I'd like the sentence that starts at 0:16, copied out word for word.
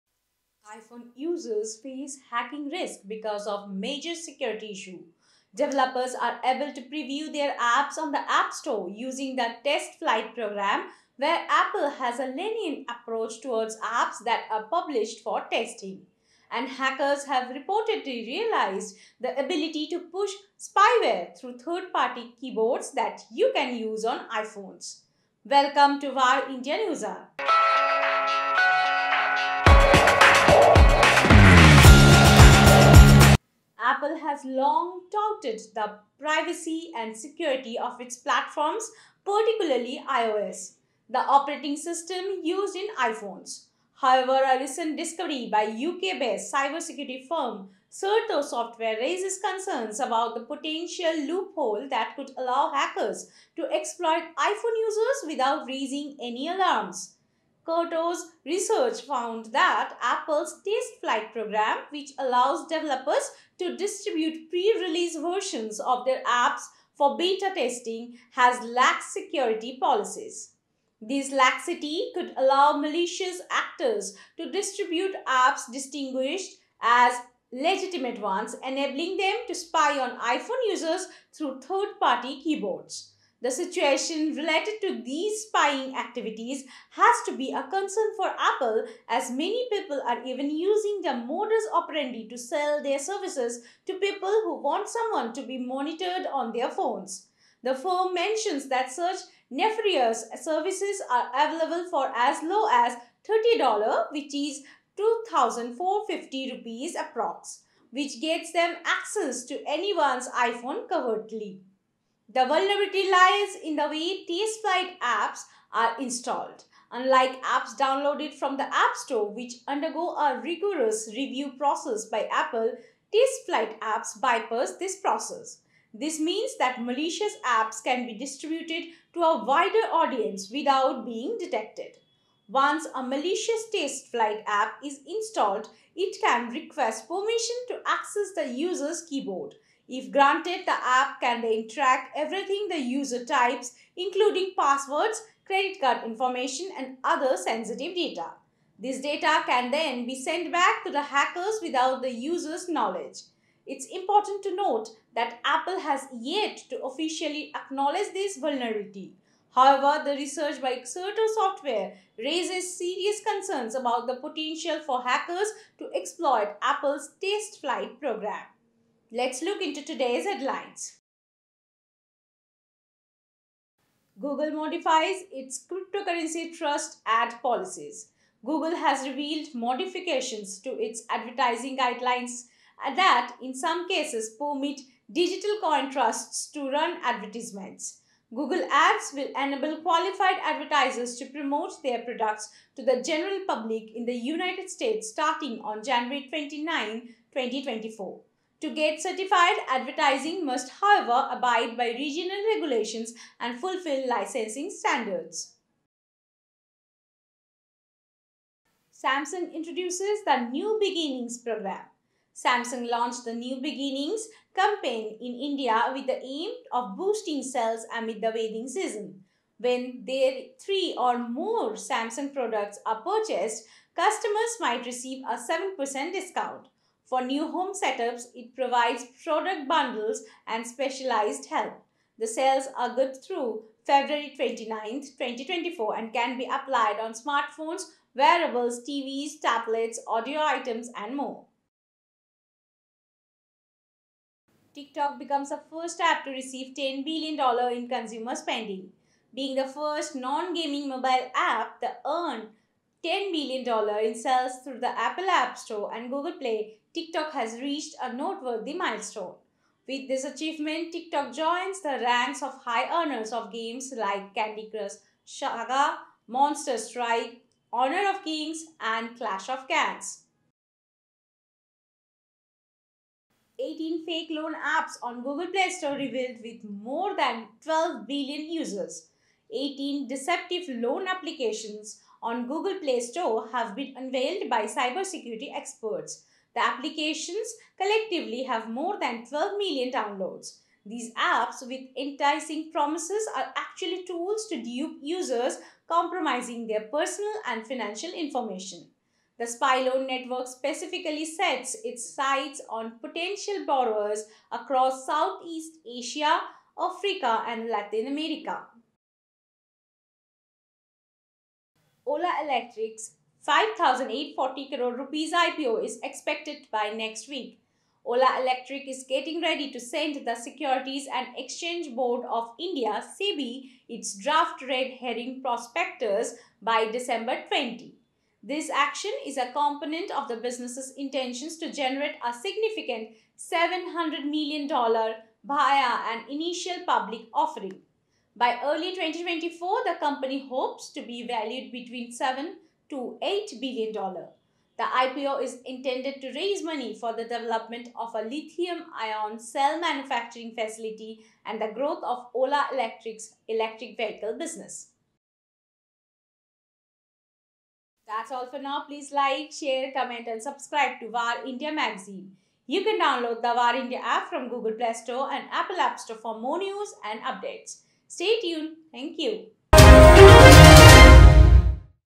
And hackers have reportedly realized the ability to push spyware through third-party keyboards that you can use on iPhones.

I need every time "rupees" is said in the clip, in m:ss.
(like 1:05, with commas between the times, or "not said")
1:46, 5:14.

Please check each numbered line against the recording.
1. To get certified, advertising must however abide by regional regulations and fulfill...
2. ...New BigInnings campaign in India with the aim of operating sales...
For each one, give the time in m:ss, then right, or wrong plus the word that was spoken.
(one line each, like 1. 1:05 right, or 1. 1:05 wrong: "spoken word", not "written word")
1. 3:18 right
2. 3:33 wrong: "boosting", not "operating".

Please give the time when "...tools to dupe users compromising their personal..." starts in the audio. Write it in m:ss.
4:54.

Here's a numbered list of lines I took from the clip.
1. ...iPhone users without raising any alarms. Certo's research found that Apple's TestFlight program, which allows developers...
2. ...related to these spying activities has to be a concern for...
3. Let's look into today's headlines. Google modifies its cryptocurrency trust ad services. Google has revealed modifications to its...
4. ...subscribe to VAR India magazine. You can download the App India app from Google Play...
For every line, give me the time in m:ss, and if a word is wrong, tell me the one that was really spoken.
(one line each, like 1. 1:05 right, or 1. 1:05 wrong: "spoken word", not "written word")
1. 0:54 right
2. 1:24 right
3. 2:49 wrong: "policies", not "services"
4. 6:00 wrong: "VAR", not "App".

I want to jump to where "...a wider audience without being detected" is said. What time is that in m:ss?
2:09.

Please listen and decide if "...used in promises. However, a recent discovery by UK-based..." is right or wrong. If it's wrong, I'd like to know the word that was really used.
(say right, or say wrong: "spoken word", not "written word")
wrong: "iPhones", not "promises".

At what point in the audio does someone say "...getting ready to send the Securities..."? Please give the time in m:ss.
5:19.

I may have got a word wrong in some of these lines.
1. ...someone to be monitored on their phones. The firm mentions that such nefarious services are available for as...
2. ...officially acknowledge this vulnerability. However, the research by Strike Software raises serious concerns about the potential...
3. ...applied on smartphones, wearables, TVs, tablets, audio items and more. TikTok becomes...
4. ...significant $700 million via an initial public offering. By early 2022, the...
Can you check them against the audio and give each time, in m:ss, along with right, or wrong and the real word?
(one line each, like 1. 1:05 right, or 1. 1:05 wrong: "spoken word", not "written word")
1. 1:34 right
2. 2:36 wrong: "Certo", not "Strike"
3. 3:56 right
4. 5:32 wrong: "2024", not "2022".